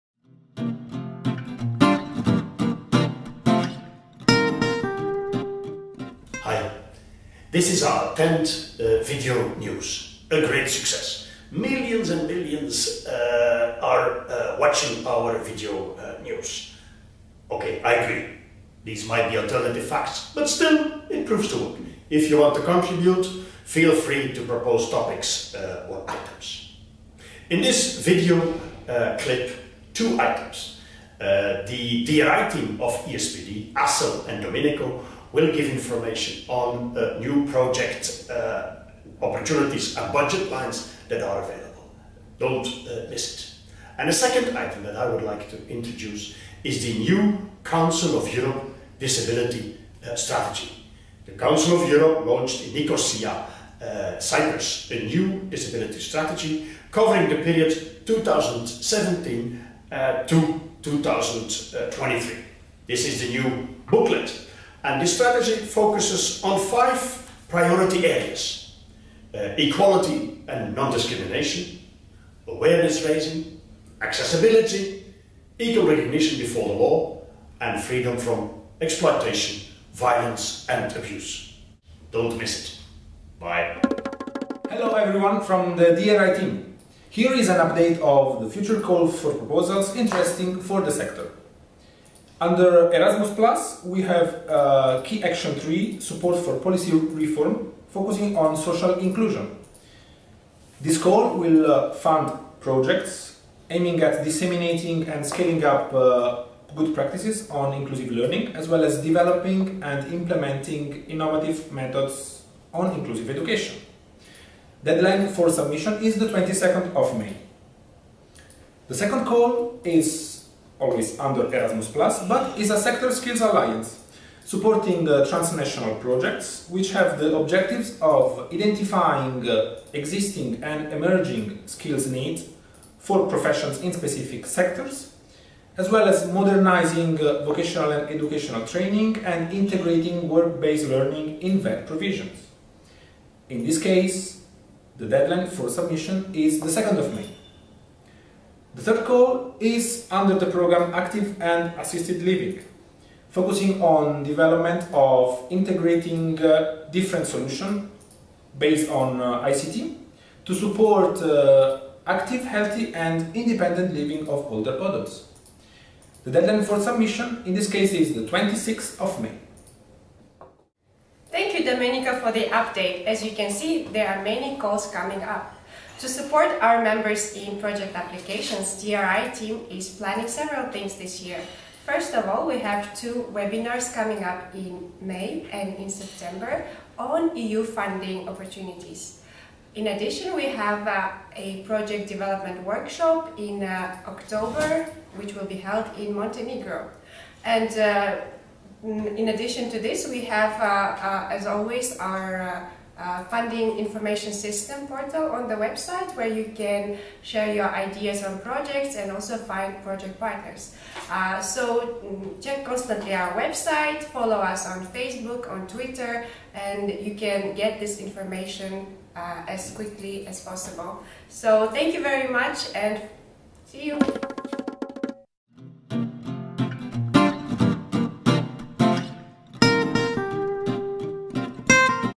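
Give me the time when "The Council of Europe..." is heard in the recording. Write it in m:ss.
0:51.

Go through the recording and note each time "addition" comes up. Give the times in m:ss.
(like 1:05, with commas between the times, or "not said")
3:09, 3:19.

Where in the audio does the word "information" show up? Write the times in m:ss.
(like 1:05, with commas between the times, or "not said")
0:35, 3:23, 3:37.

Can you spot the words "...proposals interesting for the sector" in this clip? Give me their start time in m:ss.
1:29.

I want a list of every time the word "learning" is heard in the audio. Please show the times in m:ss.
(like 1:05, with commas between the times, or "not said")
1:48, 2:20.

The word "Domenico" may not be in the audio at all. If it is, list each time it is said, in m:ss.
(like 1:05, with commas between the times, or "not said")
0:34, 2:51.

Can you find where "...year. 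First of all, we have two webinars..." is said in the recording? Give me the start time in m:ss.
3:01.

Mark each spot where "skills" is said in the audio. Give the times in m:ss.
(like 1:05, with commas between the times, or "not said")
2:03, 2:11.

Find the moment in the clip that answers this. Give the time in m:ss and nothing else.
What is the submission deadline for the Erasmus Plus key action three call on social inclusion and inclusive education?
1:56.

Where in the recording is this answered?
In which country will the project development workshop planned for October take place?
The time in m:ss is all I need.
3:16.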